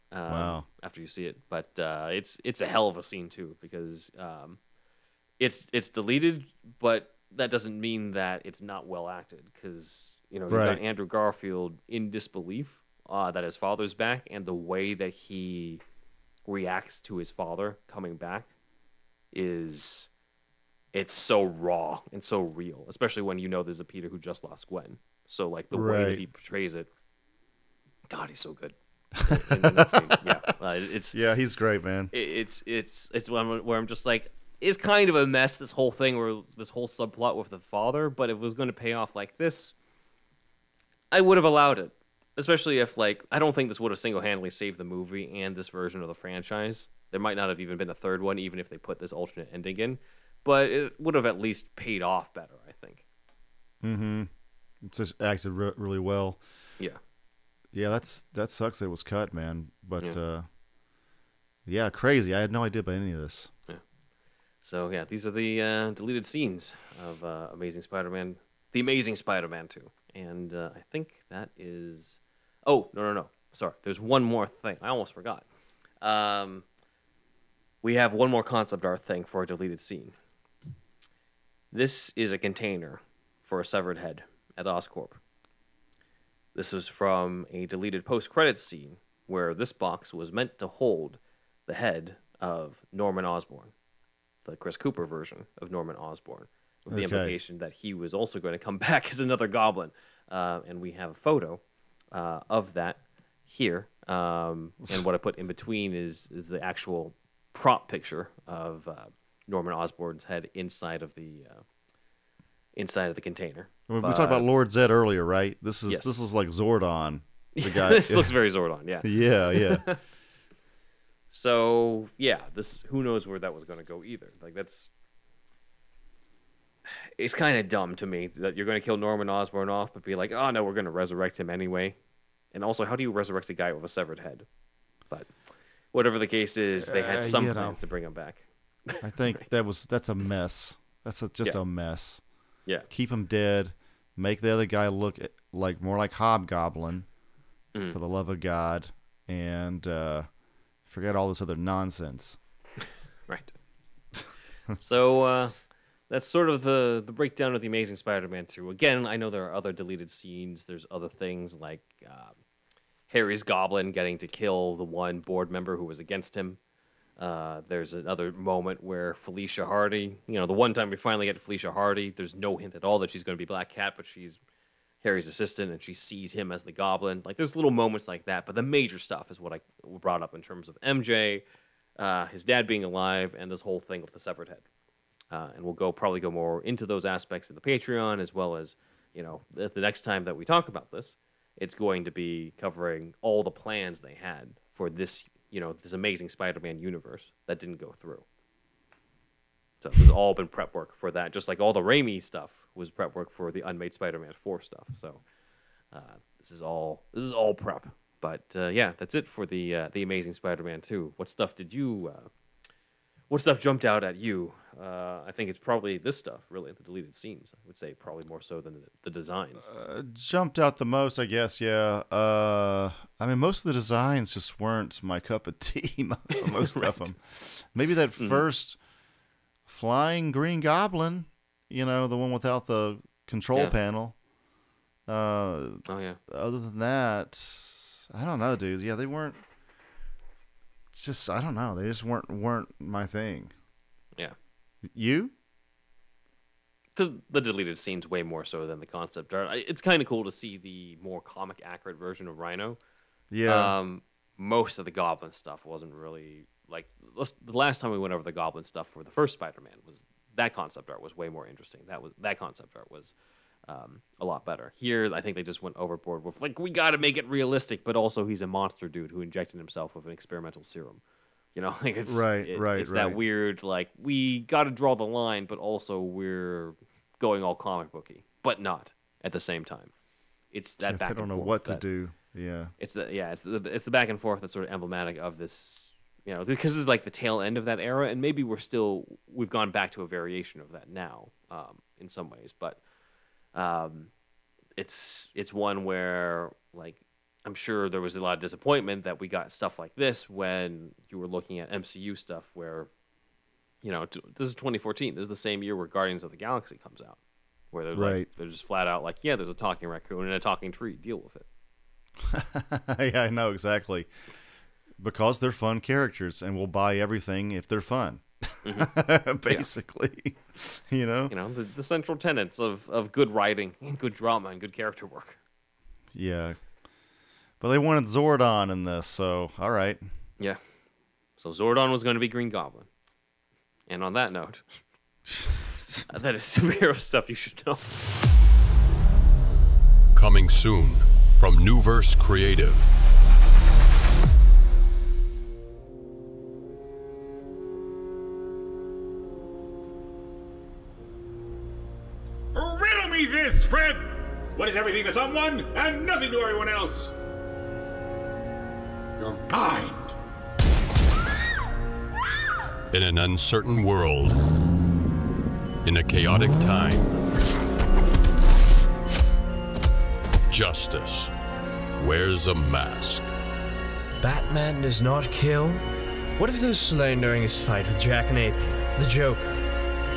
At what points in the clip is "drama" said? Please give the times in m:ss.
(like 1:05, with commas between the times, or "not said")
5:24.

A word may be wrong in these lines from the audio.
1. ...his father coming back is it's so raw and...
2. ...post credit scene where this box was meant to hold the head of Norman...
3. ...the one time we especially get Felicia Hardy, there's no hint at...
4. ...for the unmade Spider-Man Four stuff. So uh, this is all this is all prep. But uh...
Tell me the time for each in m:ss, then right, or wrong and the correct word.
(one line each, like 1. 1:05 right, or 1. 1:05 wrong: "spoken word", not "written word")
1. 0:17 right
2. 1:28 right
3. 2:50 wrong: "finally", not "especially"
4. 3:23 right.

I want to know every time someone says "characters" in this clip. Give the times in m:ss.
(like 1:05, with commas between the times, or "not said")
5:15, 5:24.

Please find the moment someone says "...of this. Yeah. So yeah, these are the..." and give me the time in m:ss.
1:03.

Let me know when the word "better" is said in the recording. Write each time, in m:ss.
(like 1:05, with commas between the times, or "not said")
0:52, 4:24.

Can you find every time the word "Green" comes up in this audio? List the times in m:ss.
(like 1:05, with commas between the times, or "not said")
3:50, 5:32.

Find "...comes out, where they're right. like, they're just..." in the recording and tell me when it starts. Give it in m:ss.
5:06.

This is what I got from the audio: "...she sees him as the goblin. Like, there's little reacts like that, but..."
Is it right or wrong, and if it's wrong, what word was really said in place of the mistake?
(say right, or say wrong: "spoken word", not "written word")
wrong: "moments", not "reacts".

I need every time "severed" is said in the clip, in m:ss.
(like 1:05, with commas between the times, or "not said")
1:23, 2:13, 3:04.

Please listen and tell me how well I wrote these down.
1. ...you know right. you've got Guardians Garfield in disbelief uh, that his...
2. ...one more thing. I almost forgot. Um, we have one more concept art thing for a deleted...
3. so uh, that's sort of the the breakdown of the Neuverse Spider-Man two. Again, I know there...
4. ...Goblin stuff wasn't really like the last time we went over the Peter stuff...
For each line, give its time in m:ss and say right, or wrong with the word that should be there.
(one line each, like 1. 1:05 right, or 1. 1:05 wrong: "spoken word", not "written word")
1. 0:10 wrong: "Andrew", not "Guardians"
2. 1:13 right
3. 2:34 wrong: "Amazing", not "Neuverse"
4. 4:14 wrong: "Goblin", not "Peter".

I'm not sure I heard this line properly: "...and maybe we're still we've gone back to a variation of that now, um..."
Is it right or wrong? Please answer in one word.
right.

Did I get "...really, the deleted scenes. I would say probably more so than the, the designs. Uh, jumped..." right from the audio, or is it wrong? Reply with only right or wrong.
right.